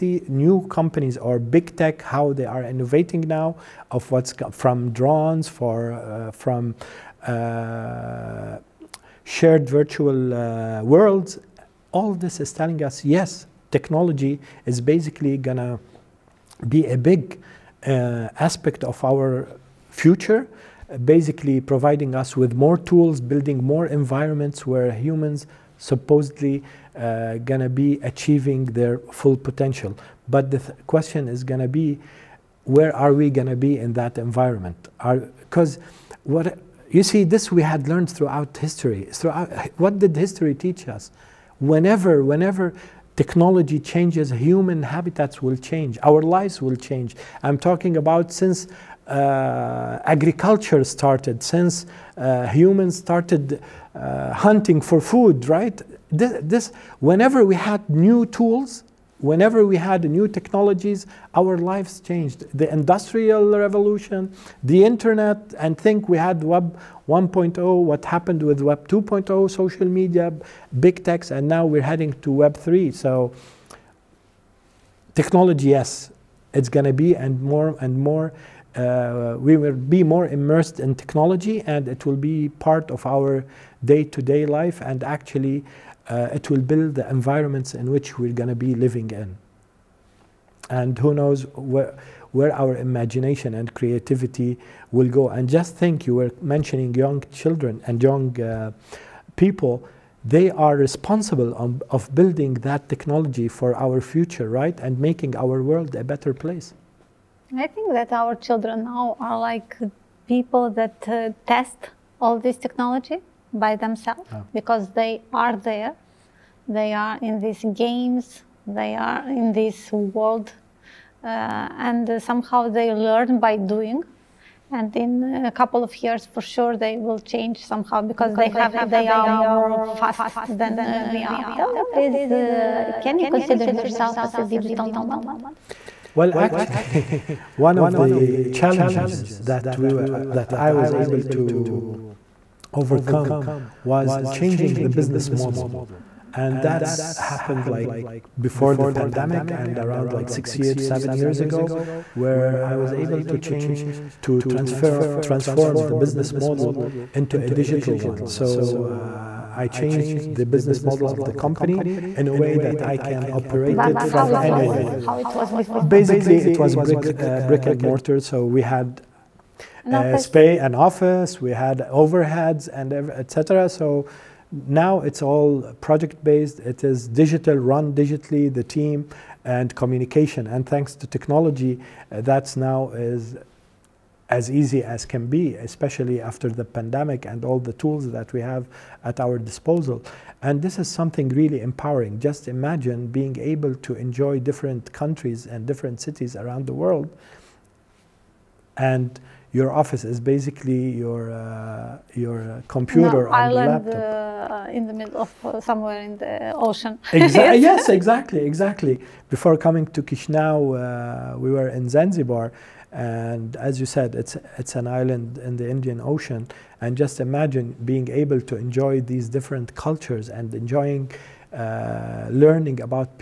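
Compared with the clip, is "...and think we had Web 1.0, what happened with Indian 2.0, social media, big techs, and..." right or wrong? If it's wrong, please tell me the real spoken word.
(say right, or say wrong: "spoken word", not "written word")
wrong: "Web", not "Indian".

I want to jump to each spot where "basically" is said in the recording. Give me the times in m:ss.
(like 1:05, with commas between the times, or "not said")
0:14, 0:21, 2:45, 3:20.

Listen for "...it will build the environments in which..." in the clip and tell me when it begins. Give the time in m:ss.
1:26.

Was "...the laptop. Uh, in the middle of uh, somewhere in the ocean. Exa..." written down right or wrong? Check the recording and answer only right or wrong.
right.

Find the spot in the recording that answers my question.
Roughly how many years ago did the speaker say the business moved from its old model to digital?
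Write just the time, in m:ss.
2:30.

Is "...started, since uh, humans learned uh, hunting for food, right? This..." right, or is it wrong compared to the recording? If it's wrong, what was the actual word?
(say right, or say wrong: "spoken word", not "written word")
wrong: "started", not "learned".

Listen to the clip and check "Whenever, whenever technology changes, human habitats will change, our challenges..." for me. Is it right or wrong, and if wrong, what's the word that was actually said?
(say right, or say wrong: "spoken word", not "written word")
wrong: "lives", not "challenges".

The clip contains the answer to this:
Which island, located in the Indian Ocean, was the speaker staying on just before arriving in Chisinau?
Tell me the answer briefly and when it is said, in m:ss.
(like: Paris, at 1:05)
Zanzibar, at 3:31.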